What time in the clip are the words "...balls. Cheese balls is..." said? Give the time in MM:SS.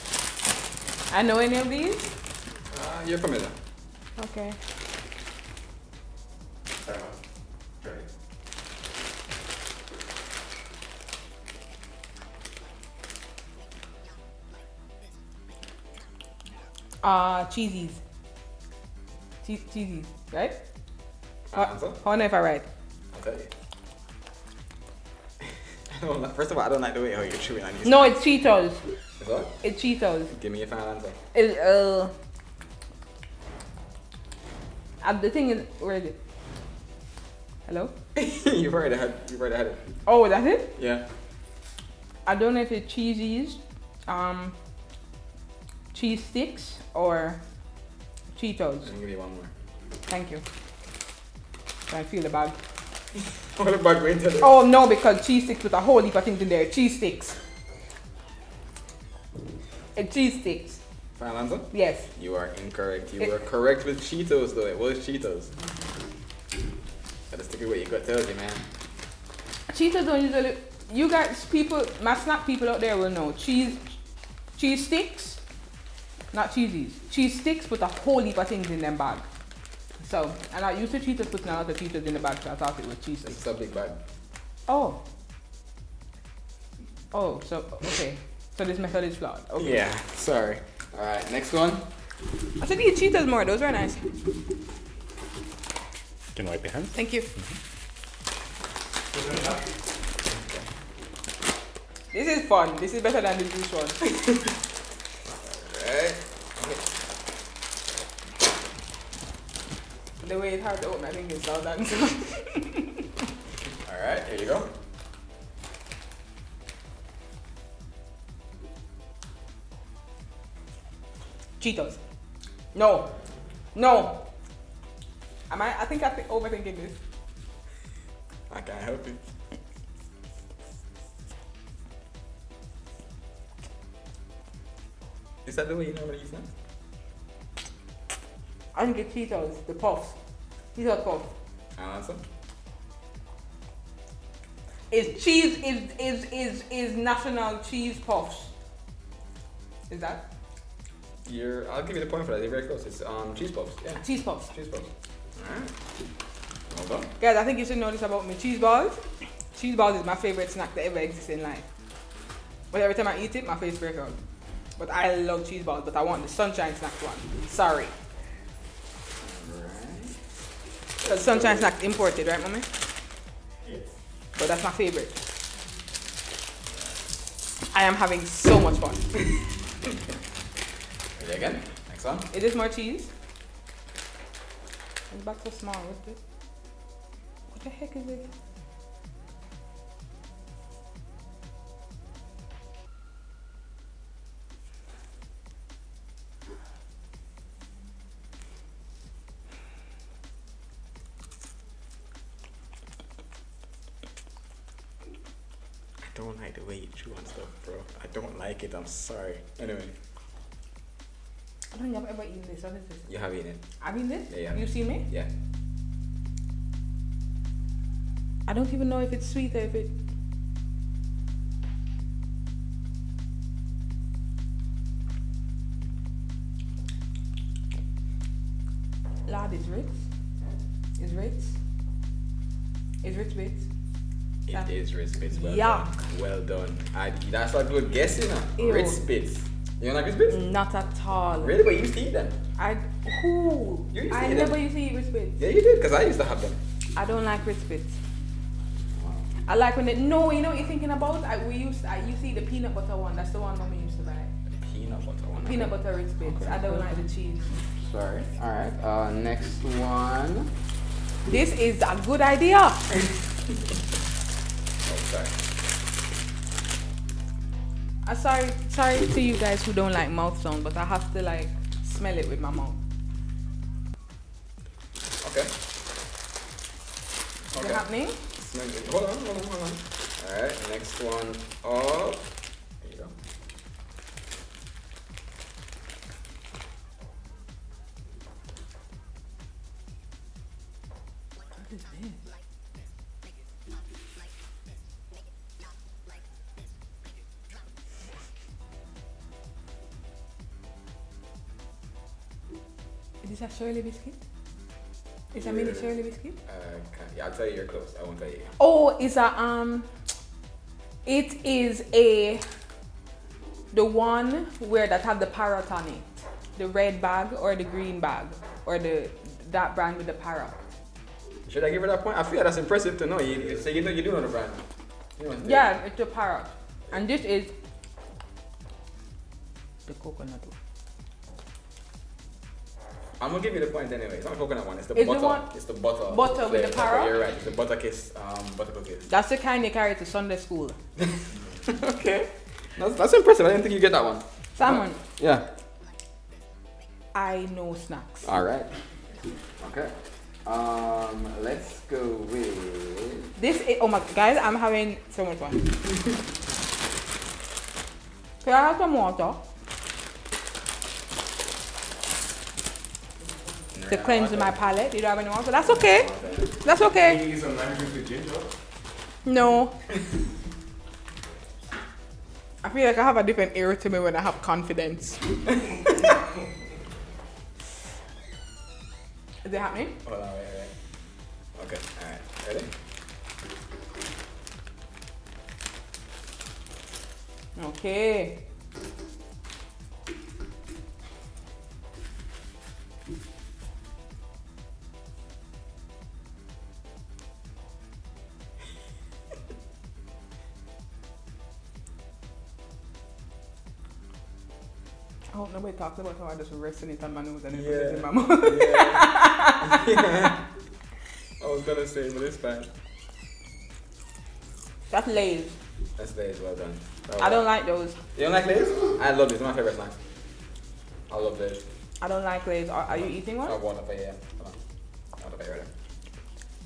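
02:38.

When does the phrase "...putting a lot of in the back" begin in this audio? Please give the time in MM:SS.
01:21.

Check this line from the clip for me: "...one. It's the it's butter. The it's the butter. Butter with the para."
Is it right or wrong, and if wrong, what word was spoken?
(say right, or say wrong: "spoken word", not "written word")
right.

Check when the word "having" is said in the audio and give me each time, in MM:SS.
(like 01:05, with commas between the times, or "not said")
02:57, 05:54.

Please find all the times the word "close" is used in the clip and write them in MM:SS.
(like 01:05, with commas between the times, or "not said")
02:32, 05:07.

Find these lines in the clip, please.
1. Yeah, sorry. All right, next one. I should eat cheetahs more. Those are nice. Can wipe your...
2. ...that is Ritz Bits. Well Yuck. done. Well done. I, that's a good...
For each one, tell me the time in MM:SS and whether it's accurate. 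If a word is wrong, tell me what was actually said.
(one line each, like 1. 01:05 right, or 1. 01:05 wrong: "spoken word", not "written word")
1. 01:29 right
2. 03:54 right.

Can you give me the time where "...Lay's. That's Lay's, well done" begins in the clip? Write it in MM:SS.
06:55.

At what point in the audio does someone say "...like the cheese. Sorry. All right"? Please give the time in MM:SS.
04:16.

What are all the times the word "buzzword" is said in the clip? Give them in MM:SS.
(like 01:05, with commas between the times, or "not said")
not said.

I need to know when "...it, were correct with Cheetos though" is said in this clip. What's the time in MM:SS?
01:03.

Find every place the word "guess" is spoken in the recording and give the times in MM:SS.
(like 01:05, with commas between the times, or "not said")
03:57.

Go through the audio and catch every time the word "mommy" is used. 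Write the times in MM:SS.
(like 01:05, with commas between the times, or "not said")
02:52, 04:13.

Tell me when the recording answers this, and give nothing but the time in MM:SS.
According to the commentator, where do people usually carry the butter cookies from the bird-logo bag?
05:40.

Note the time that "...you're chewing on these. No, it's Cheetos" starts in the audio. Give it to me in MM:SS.
00:27.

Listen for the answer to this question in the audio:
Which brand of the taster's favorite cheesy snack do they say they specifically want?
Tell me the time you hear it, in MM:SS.
02:46.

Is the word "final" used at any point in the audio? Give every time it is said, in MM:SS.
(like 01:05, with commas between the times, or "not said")
00:30, 01:01.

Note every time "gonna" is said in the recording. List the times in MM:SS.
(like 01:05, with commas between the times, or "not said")
05:33, 06:51.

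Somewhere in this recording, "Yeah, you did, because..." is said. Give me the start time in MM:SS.
04:05.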